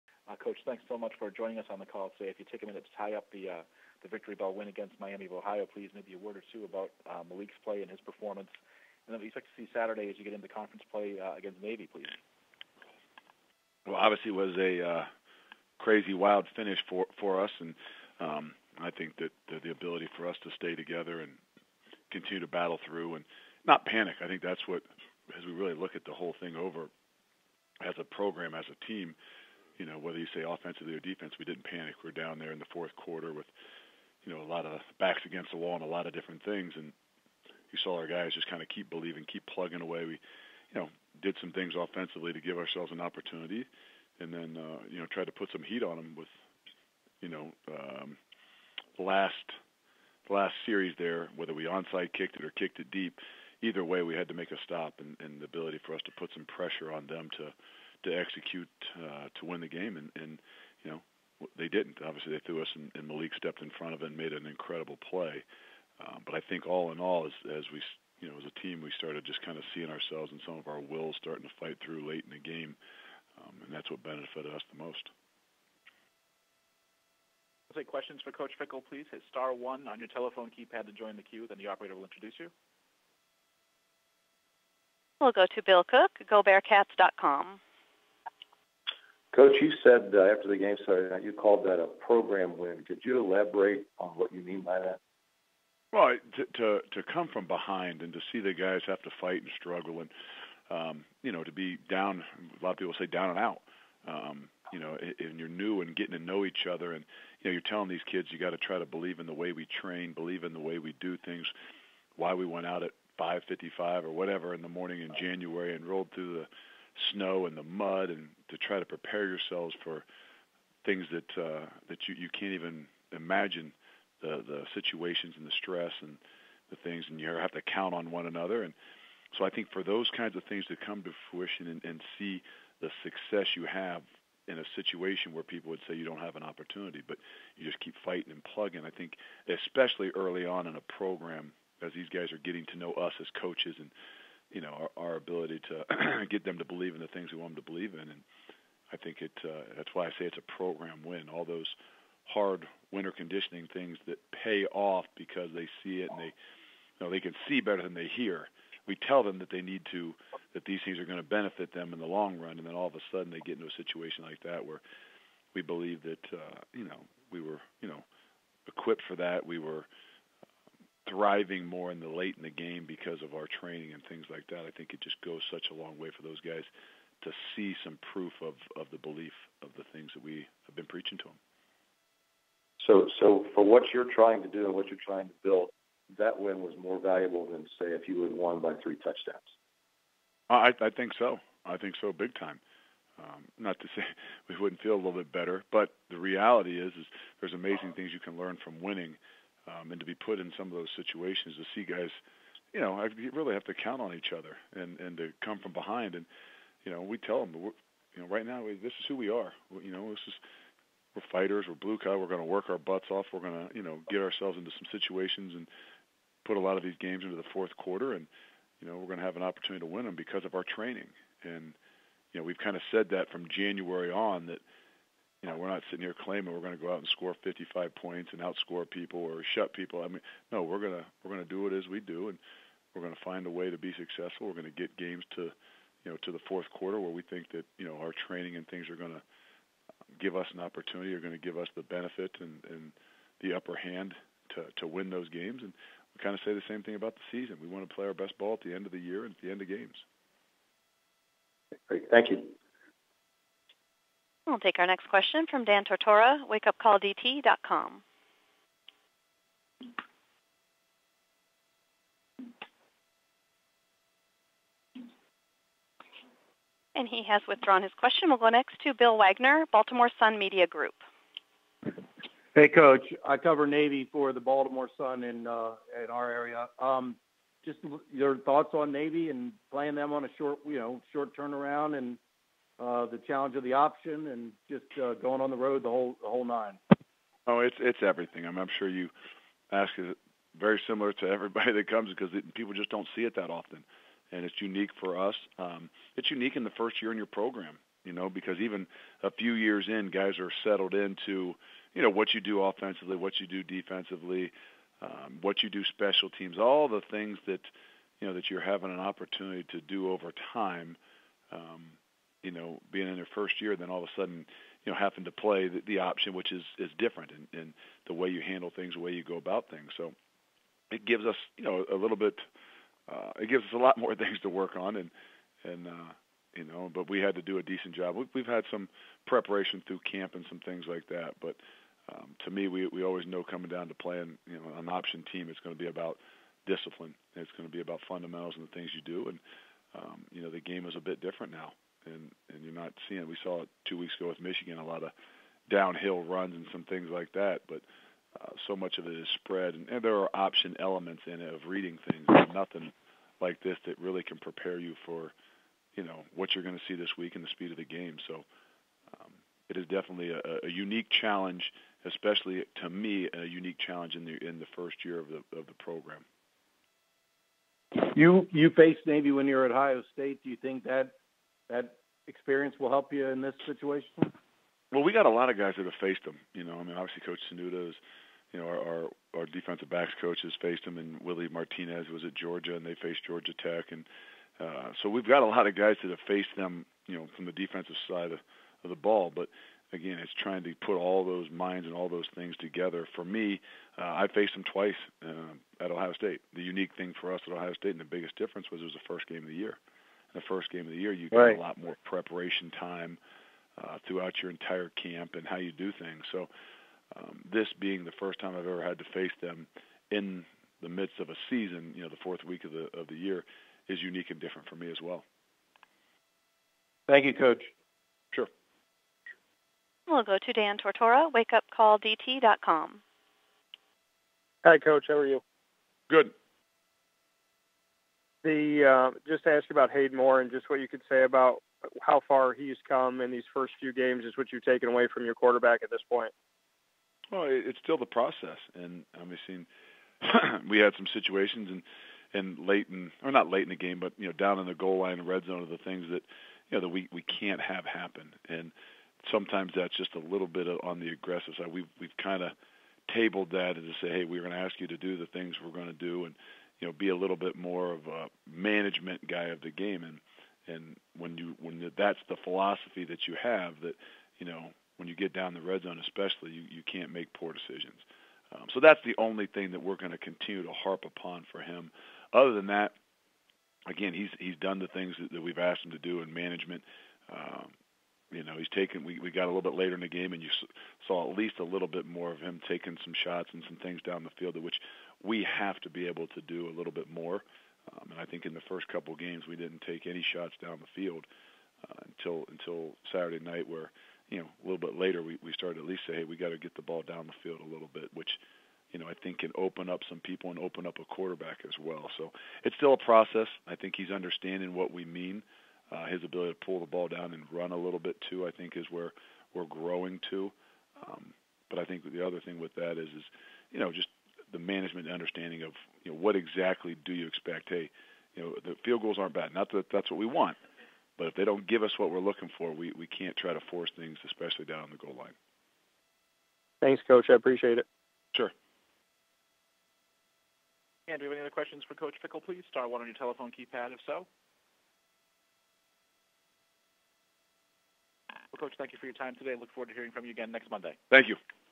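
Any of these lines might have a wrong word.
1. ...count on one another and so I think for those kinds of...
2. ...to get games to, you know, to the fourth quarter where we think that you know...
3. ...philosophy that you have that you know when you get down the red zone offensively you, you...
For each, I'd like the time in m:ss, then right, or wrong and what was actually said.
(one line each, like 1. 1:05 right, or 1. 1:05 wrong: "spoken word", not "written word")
1. 2:07 right
2. 3:54 right
3. 7:42 wrong: "especially", not "offensively".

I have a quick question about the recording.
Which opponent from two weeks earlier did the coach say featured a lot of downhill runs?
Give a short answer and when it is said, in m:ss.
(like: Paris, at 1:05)
Michigan, at 5:44.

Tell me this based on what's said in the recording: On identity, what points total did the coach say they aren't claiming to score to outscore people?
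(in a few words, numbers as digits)
55.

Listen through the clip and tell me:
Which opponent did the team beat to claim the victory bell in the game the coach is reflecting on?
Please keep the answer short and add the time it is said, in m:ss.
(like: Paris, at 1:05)
Miami of Ohio, at 0:04.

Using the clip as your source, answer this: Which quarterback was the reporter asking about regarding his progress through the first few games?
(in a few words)
Hayden Moore.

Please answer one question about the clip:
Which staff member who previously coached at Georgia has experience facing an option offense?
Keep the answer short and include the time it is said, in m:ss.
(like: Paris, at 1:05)
Willie Martinez, at 6:21.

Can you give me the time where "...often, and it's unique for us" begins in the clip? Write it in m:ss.
4:53.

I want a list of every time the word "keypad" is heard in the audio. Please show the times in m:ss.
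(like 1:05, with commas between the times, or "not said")
1:20, 8:53.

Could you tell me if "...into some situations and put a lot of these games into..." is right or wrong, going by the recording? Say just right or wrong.
right.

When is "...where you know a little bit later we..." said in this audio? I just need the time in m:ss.
8:13.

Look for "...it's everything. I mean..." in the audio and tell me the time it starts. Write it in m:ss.
4:47.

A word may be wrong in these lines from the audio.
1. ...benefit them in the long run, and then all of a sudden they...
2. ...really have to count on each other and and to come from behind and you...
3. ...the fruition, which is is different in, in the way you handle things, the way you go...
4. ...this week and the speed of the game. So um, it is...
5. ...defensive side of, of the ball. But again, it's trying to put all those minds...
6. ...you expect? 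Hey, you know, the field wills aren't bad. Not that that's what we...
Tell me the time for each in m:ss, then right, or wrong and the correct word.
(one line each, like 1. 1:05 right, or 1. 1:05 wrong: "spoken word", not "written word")
1. 2:41 right
2. 3:23 right
3. 5:15 wrong: "option", not "fruition"
4. 5:56 right
5. 6:27 right
6. 8:37 wrong: "goals", not "wills".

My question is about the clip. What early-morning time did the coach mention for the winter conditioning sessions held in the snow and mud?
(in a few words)
5:55.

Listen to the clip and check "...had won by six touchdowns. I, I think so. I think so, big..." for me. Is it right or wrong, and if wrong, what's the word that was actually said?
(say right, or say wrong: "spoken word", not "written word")
wrong: "three", not "six".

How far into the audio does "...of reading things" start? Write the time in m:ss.
5:51.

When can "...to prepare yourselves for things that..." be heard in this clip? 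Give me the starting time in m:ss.
1:58.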